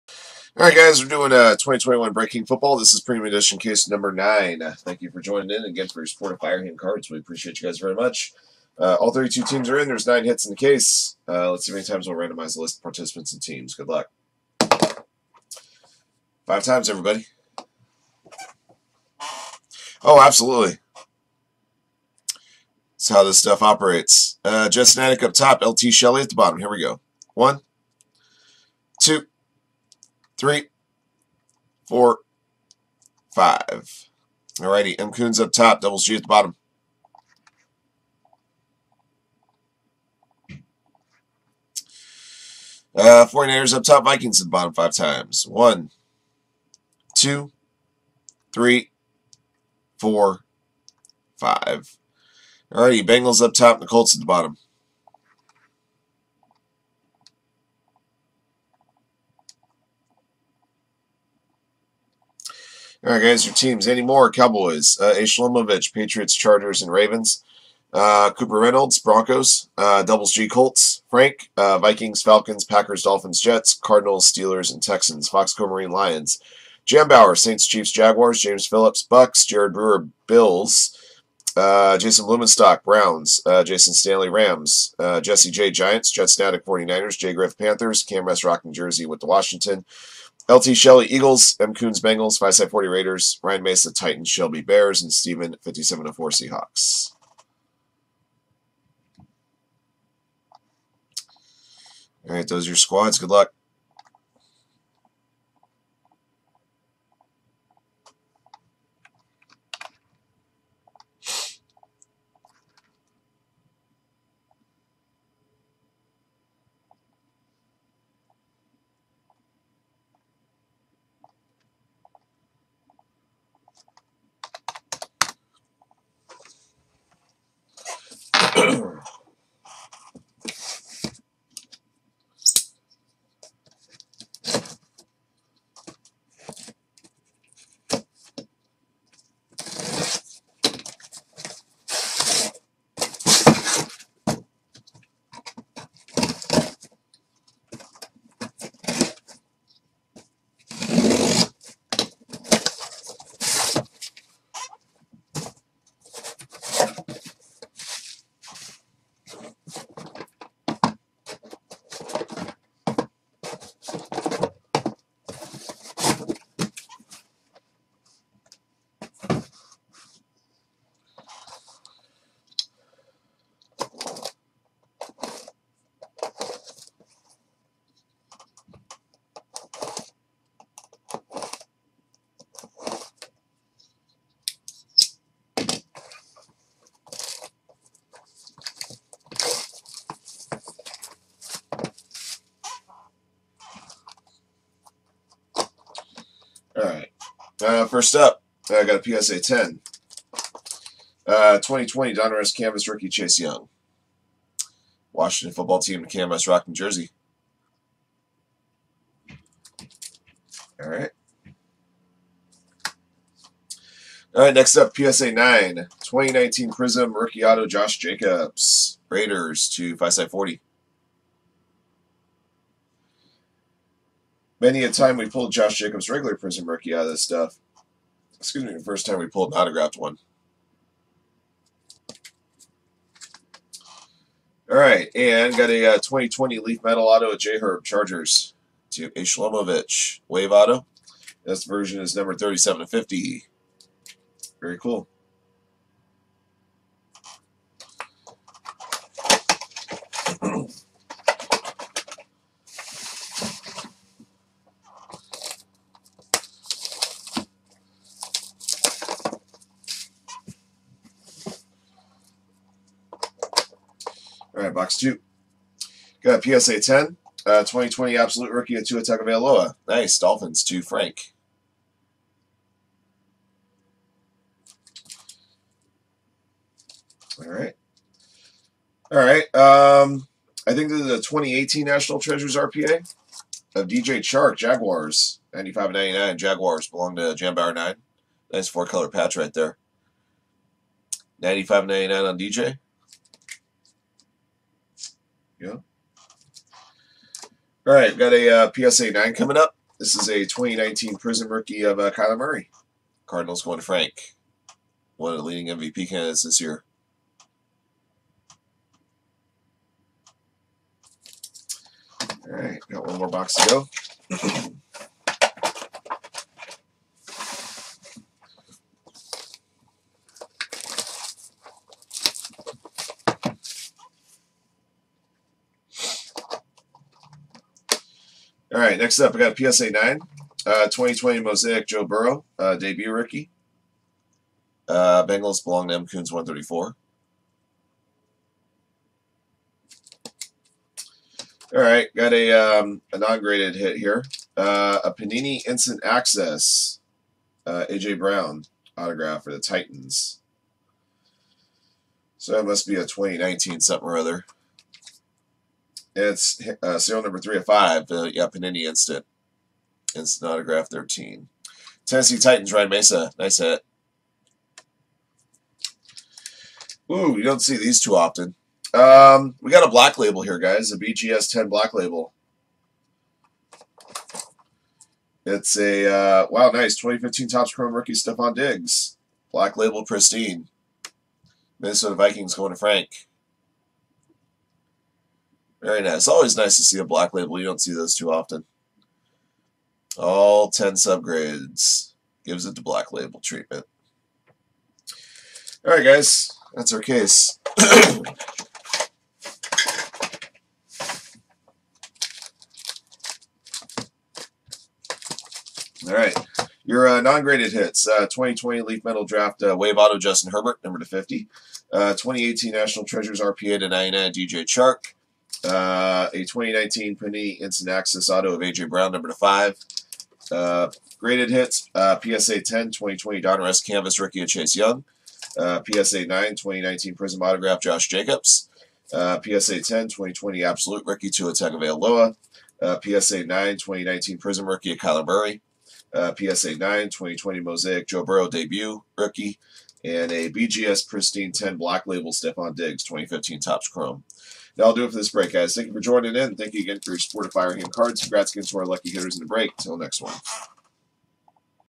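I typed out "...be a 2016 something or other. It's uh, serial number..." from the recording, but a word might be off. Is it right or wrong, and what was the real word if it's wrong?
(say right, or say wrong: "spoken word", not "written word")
wrong: "2019", not "2016".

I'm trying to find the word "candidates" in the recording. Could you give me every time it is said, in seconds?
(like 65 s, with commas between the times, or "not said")
306 s.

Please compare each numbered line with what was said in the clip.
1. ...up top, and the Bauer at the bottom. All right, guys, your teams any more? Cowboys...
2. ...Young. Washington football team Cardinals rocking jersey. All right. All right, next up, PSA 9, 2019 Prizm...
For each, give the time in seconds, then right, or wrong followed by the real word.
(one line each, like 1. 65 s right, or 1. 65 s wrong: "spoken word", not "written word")
1. 53 s wrong: "Colts", not "Bauer"
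2. 203 s wrong: "Canvas", not "Cardinals".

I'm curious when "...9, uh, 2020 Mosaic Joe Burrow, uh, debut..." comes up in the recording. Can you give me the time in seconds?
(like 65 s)
329 s.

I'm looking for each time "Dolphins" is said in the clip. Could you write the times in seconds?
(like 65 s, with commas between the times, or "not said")
73 s, 270 s.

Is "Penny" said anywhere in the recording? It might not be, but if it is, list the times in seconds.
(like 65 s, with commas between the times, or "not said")
417 s.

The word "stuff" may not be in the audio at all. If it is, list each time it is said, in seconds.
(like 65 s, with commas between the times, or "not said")
23 s, 227 s.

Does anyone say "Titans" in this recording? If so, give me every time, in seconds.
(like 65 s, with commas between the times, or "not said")
93 s, 349 s, 362 s.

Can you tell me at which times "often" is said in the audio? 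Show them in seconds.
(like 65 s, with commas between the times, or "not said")
368 s, 388 s.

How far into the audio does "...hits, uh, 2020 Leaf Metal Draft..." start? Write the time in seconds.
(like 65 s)
407 s.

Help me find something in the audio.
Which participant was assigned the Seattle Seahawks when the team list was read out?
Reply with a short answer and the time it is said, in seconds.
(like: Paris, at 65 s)
Steven 4, at 95 s.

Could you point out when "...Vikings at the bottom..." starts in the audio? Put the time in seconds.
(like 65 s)
44 s.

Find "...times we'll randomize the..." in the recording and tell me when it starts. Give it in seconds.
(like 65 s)
11 s.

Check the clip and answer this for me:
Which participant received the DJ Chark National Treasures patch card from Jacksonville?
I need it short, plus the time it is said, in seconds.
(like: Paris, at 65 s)
Jambauer 9, at 287 s.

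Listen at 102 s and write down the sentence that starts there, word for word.
All right, those are your squads.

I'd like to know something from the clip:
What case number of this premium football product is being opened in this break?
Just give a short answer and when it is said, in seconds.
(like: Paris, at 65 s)
9, at 3 s.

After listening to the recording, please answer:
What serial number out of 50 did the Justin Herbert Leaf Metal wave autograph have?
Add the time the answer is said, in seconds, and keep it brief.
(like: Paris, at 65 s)
37, at 242 s.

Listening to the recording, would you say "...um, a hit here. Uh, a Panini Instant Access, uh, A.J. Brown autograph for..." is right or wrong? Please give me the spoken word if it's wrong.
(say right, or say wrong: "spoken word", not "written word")
right.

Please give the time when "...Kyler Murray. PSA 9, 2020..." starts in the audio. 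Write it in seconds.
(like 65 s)
434 s.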